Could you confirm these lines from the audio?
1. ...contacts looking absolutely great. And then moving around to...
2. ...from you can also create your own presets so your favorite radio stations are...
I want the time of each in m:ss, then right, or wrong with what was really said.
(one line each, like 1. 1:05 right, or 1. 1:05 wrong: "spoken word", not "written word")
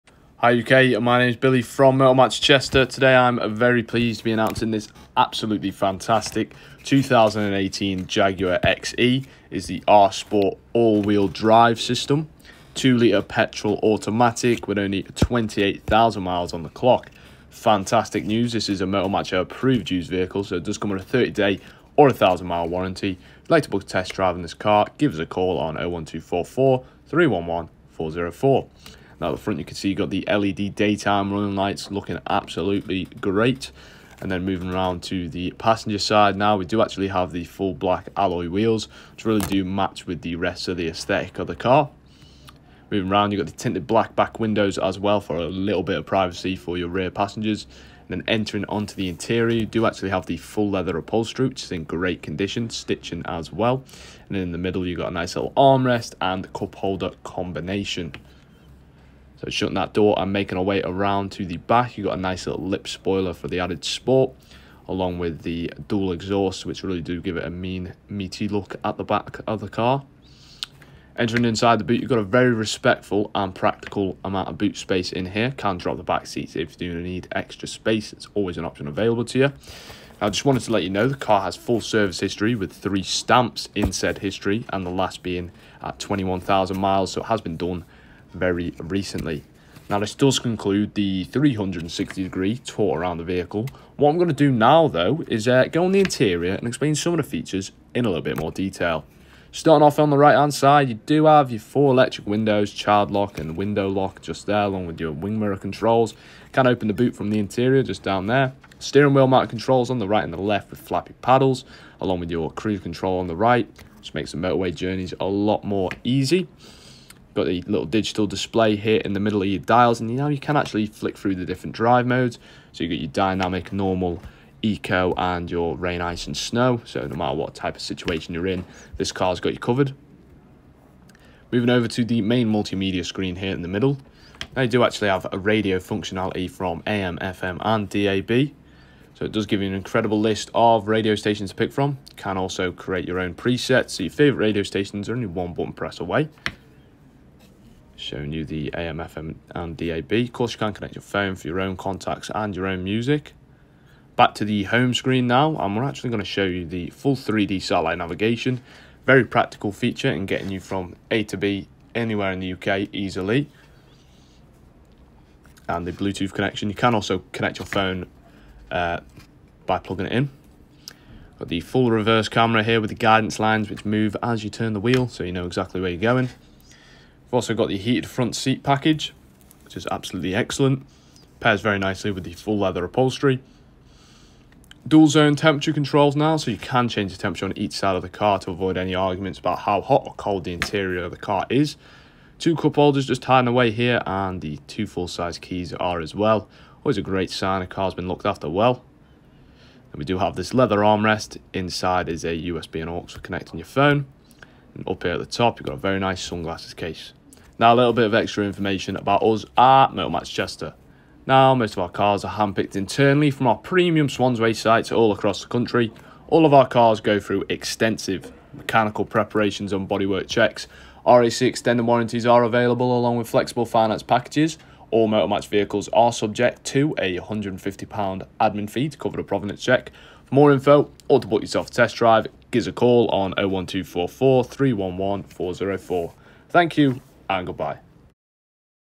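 1. 0:31 wrong: "lights", not "contacts"
2. 2:21 right.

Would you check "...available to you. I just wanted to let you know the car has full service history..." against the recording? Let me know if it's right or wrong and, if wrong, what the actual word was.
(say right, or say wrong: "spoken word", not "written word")
right.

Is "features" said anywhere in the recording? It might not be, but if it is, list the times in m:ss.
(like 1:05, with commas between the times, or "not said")
1:37, 2:39.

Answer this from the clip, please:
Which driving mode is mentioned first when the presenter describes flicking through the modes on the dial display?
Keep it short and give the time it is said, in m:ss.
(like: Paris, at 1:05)
Dynamic, at 2:03.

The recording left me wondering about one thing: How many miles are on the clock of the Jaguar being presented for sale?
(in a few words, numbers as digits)
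28,000.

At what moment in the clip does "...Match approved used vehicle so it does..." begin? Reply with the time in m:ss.
0:19.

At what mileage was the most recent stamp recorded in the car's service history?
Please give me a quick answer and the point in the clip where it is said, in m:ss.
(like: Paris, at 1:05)
21,000 miles, at 1:25.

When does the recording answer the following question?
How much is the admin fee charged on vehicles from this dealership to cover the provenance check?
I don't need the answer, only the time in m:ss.
3:47.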